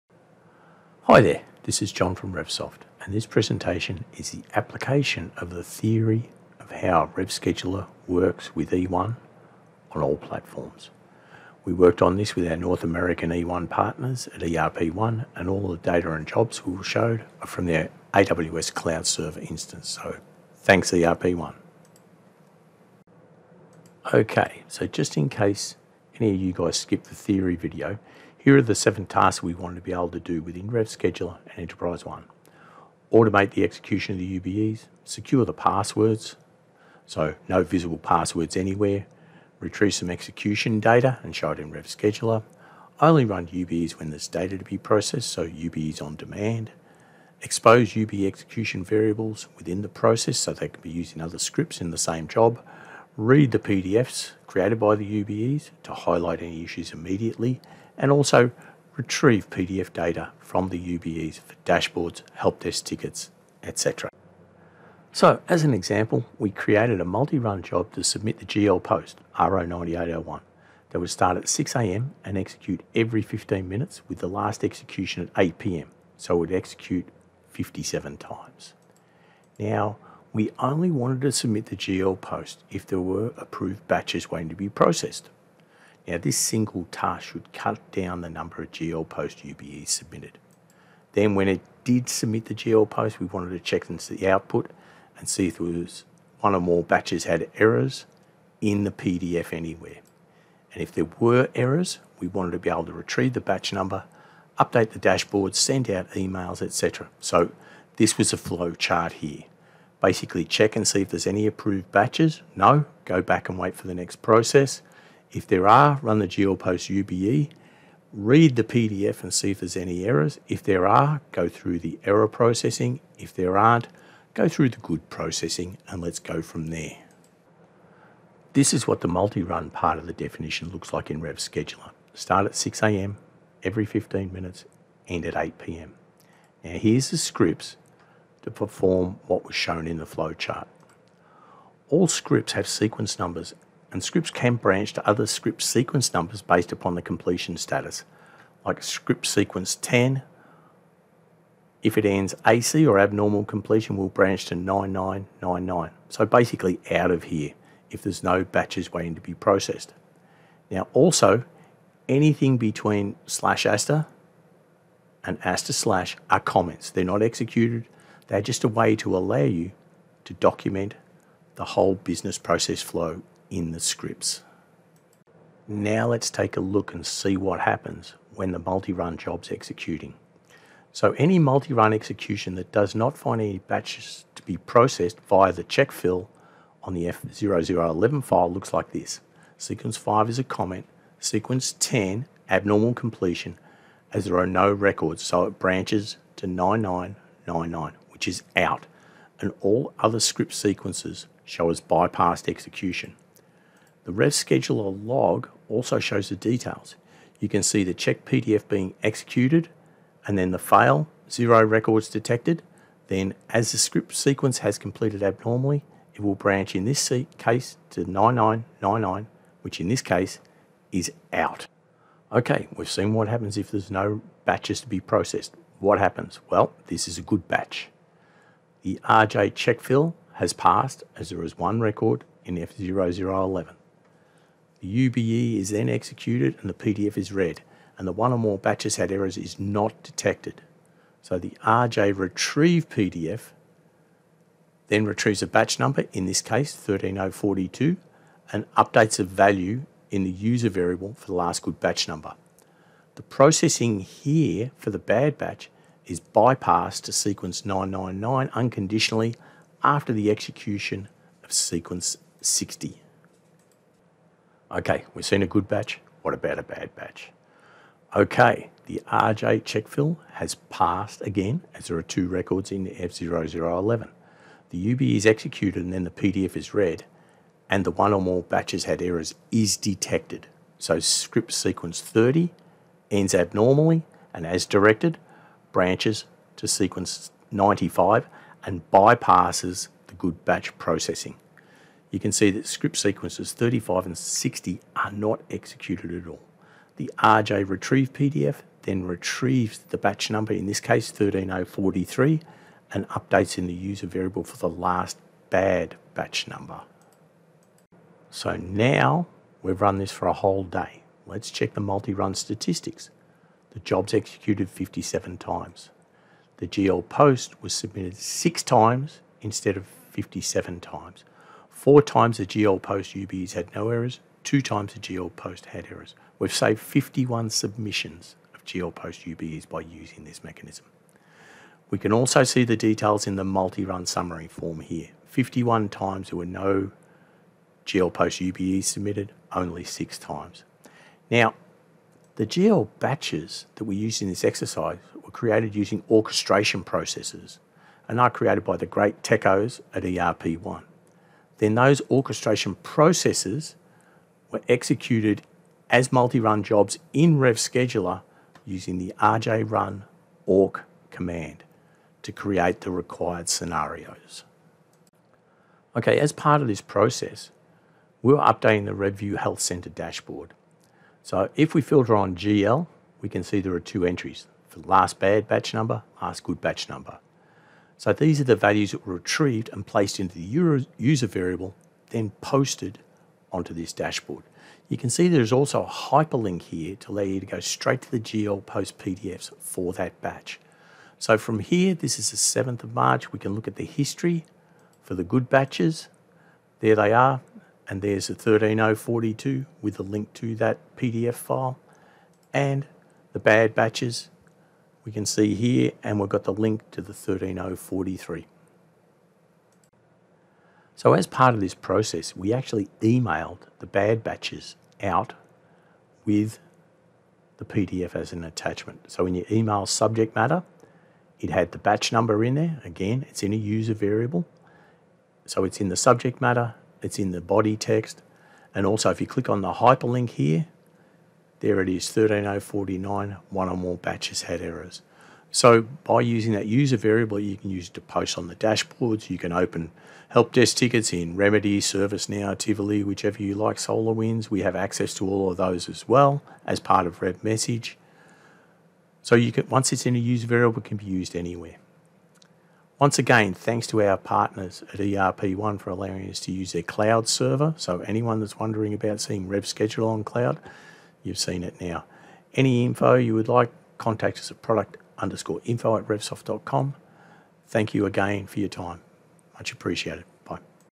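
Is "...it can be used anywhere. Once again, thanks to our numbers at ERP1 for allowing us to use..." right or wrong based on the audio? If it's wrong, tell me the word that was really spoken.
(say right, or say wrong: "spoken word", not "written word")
wrong: "partners", not "numbers".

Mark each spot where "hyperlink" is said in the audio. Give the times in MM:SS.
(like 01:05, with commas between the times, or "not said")
06:25, 07:09.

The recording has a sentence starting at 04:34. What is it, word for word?
The UB is executed and then the PDF is read and the one or more batches had errors is detected.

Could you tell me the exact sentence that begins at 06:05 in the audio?
Okay, as part of this process, we we're updating the RevView Health Center dashboard.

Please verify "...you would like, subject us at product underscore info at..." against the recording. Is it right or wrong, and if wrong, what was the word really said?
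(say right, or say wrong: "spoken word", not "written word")
wrong: "contact", not "subject".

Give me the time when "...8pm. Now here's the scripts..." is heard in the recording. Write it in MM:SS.
02:15.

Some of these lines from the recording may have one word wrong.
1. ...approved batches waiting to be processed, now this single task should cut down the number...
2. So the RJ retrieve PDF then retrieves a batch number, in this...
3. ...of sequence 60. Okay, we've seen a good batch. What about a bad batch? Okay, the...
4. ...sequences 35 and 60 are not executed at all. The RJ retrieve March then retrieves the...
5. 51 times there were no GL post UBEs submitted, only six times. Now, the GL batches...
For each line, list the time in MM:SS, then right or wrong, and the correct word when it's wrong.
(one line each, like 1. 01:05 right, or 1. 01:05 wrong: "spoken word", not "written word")
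1. 01:23 right
2. 04:01 right
3. 04:21 right
4. 04:52 wrong: "PDF", not "March"
5. 05:35 right.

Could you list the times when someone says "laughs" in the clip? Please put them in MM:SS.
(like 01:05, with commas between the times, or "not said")
not said.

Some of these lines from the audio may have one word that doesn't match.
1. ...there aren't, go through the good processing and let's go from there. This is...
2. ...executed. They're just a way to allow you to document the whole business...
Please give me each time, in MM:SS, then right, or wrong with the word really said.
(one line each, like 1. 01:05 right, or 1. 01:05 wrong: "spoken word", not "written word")
1. 02:03 right
2. 02:47 right.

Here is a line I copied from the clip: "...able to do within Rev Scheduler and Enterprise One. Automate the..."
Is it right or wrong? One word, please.
right.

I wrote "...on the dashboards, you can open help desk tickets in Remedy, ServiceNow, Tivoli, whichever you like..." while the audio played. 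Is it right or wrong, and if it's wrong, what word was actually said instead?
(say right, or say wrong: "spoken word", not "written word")
right.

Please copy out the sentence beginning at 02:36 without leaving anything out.
So basically out of here if there's no batches waiting to be processed.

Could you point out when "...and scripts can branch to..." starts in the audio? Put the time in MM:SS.
02:23.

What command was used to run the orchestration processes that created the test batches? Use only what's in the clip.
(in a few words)
RJ run orc.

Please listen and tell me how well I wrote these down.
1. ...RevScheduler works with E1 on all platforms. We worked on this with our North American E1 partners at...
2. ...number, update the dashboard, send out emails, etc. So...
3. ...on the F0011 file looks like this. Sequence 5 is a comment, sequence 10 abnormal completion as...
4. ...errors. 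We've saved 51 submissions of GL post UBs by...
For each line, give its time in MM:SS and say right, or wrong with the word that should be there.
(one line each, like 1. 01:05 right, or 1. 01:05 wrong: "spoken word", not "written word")
1. 00:07 right
2. 01:43 right
3. 03:06 right
4. 05:25 right.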